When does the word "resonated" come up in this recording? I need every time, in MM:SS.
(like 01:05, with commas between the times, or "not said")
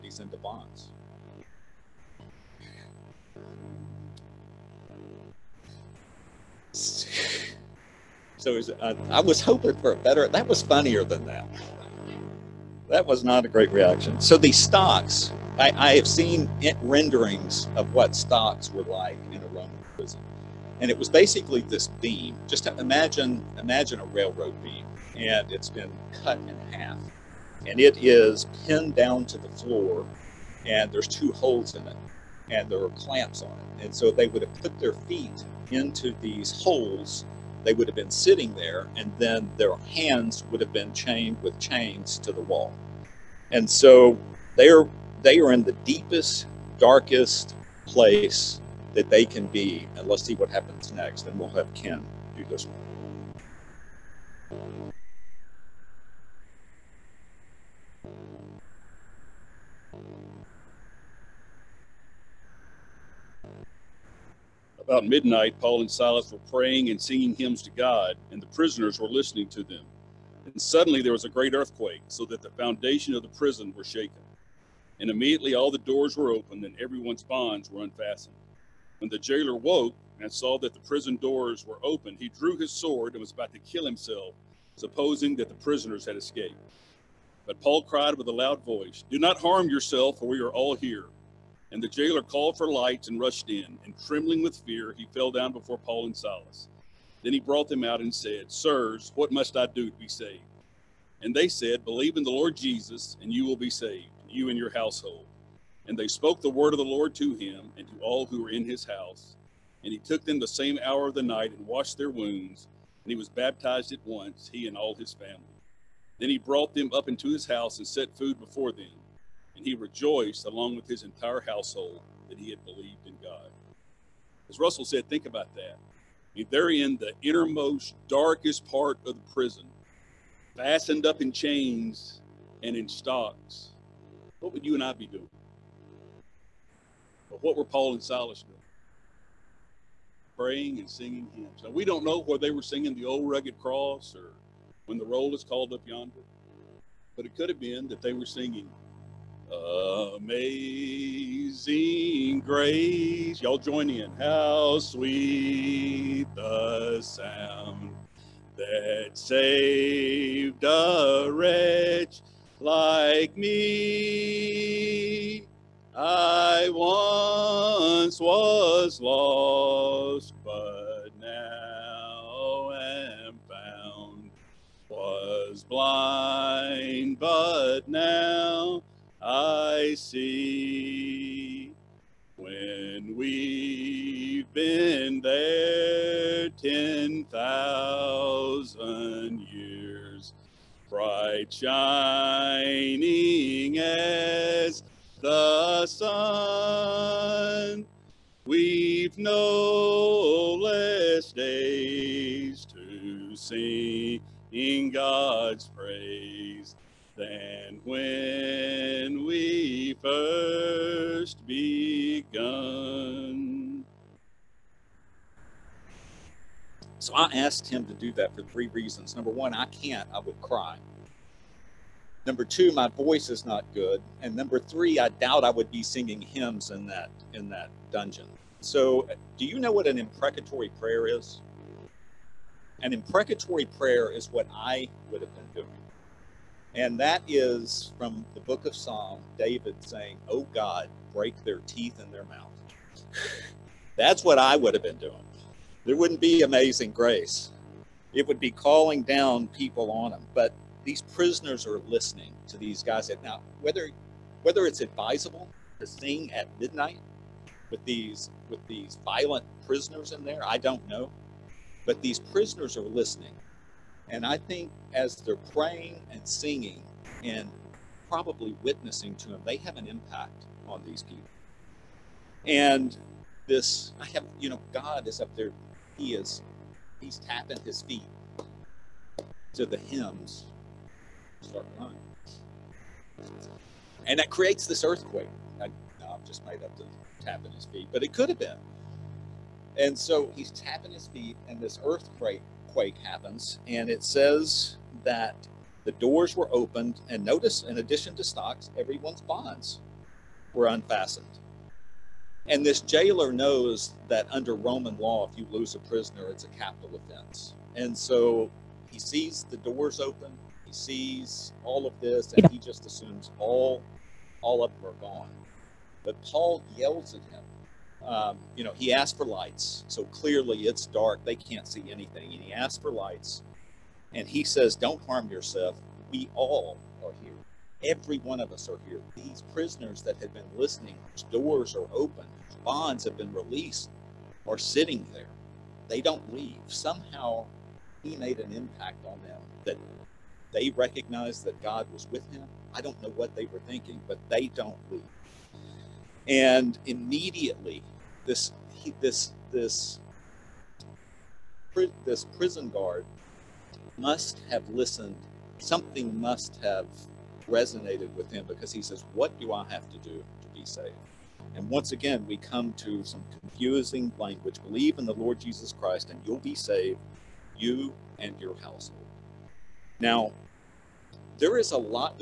05:57.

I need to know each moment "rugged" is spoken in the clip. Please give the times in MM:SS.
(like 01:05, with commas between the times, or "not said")
02:23.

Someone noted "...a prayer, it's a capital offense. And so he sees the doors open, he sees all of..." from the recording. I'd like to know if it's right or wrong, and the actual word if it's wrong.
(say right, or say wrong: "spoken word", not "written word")
wrong: "prisoner", not "prayer".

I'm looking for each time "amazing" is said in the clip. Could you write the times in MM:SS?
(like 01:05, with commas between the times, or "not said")
02:30, 04:06.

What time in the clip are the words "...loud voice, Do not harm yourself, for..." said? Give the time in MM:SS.
01:28.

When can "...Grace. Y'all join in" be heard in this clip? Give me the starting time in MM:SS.
02:32.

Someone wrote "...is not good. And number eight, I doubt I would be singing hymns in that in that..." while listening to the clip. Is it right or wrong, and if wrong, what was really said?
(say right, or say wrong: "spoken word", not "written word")
wrong: "three", not "eight".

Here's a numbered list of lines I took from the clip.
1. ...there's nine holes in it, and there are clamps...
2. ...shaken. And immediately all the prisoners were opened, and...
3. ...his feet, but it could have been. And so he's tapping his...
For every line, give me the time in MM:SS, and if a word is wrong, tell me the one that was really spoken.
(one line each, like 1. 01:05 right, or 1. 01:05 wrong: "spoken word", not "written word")
1. 00:30 wrong: "two", not "nine"
2. 01:13 wrong: "doors", not "prisoners"
3. 04:47 right.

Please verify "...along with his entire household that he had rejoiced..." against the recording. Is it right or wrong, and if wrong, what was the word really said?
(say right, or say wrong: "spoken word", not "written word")
wrong: "believed", not "rejoiced".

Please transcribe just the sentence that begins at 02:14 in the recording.
What would you and I be doing?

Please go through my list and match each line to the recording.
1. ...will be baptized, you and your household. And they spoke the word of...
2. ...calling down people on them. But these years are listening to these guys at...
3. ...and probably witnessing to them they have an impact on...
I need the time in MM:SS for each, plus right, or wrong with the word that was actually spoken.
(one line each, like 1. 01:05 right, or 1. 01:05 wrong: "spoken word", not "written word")
1. 01:43 wrong: "saved", not "baptized"
2. 04:08 wrong: "prisoners", not "years"
3. 04:27 right.